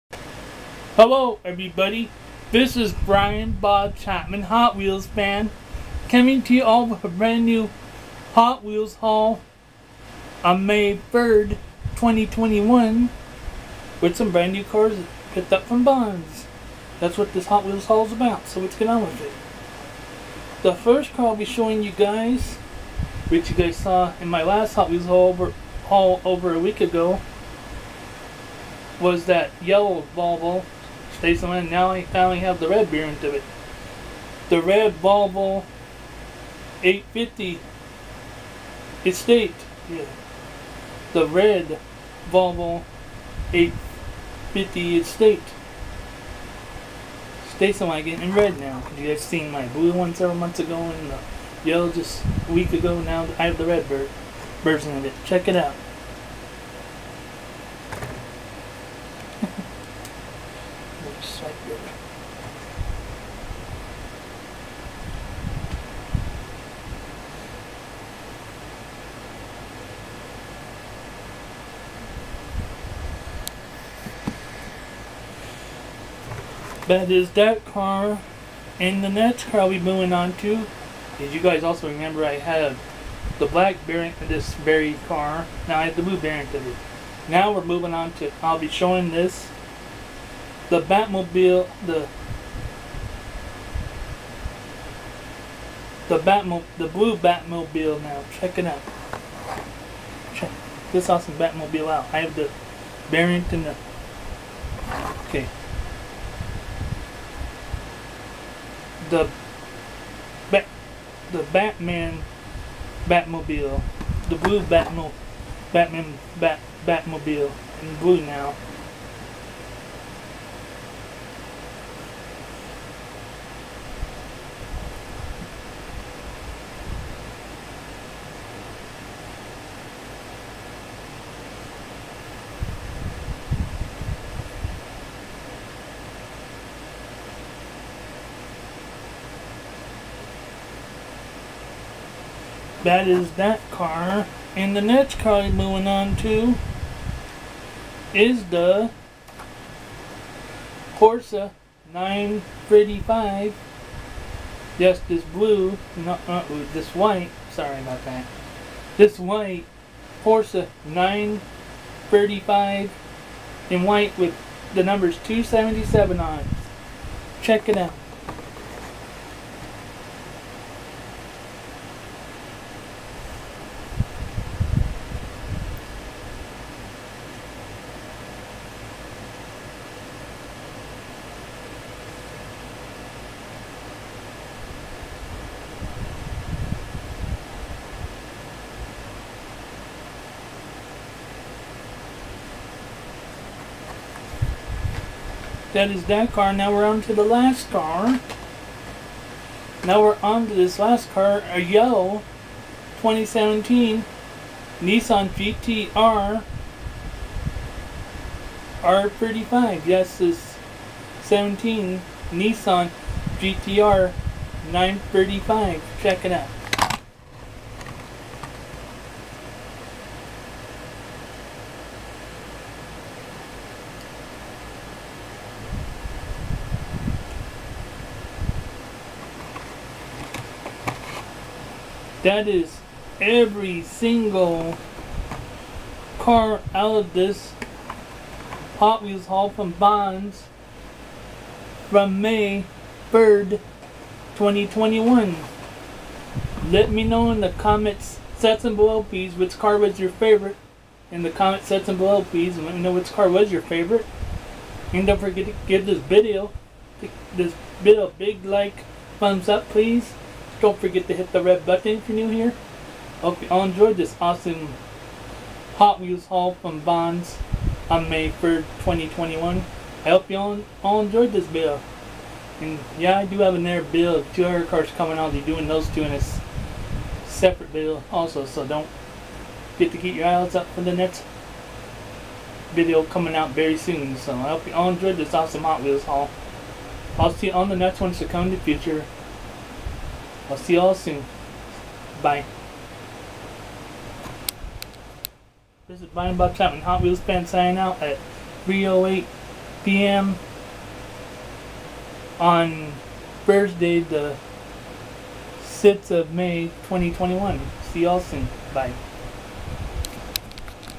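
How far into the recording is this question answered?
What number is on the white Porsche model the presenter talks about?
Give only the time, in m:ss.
2:45.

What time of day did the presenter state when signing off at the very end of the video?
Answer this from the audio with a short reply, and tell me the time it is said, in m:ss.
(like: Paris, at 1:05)
3:08 p.m., at 4:58.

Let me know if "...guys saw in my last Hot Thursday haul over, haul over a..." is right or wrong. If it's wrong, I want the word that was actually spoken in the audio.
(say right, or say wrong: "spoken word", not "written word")
wrong: "Wheels", not "Thursday".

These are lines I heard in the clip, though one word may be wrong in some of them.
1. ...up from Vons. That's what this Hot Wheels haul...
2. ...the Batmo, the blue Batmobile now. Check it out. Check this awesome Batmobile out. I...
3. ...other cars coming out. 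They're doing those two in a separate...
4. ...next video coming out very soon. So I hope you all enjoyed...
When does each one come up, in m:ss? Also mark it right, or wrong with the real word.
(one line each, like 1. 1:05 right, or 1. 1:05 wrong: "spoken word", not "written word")
1. 0:15 right
2. 1:36 right
3. 4:34 right
4. 4:40 right.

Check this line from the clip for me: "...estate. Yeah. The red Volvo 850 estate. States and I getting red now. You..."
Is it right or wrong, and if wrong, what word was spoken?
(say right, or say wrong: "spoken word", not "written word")
right.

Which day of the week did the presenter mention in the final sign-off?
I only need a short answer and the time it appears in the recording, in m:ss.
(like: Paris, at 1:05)
Thursday, at 5:03.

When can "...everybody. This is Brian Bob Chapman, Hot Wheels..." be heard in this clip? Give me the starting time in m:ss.
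0:01.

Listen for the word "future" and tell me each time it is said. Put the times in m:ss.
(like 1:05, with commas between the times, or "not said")
4:48.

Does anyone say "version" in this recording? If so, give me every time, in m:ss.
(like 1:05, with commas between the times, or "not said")
0:54.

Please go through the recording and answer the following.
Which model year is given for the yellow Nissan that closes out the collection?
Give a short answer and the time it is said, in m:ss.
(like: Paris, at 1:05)
2017, at 3:23.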